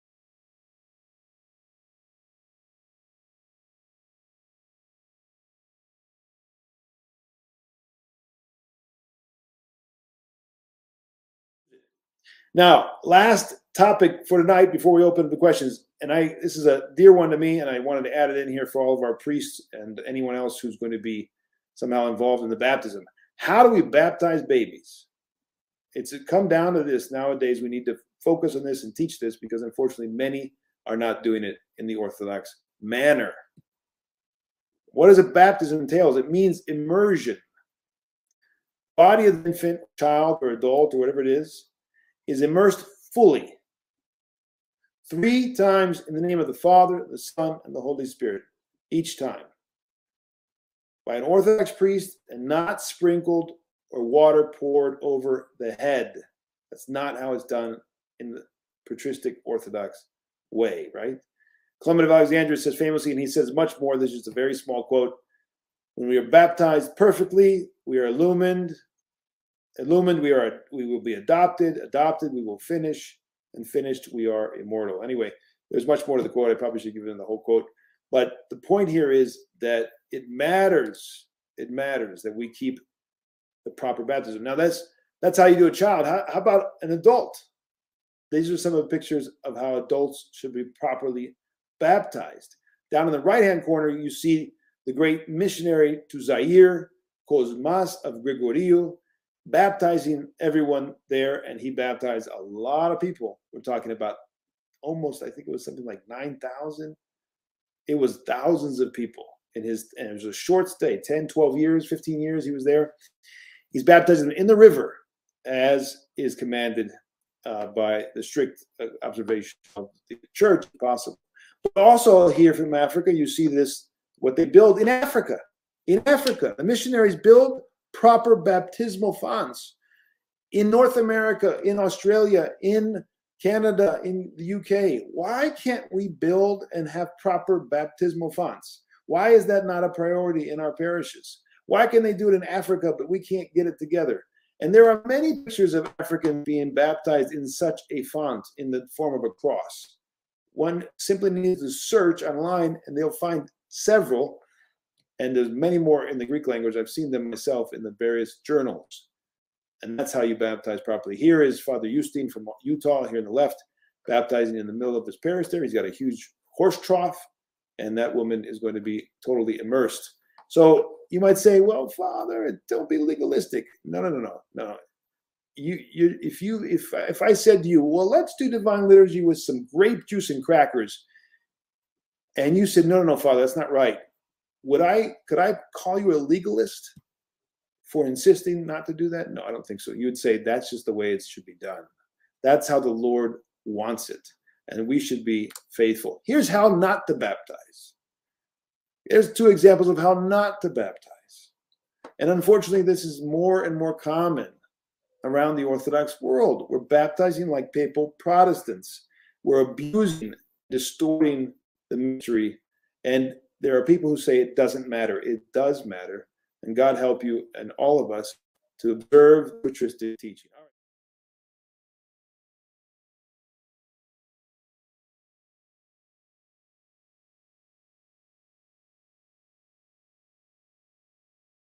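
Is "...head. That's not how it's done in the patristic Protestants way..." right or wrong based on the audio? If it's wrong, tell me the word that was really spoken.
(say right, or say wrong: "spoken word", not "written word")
wrong: "Orthodox", not "Protestants".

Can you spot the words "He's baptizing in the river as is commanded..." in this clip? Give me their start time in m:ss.
1:53.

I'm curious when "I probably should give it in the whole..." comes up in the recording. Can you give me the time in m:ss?
1:16.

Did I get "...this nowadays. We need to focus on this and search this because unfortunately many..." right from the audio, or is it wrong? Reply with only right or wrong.
wrong.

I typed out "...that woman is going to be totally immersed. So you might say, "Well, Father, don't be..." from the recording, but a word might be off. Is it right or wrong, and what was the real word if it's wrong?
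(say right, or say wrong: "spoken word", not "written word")
right.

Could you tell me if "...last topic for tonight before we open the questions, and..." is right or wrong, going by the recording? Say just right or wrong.
right.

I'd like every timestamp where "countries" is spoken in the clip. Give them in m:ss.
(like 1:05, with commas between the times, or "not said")
not said.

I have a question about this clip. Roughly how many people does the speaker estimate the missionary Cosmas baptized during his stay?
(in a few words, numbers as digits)
9,000.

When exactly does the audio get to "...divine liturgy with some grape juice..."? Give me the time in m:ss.
2:58.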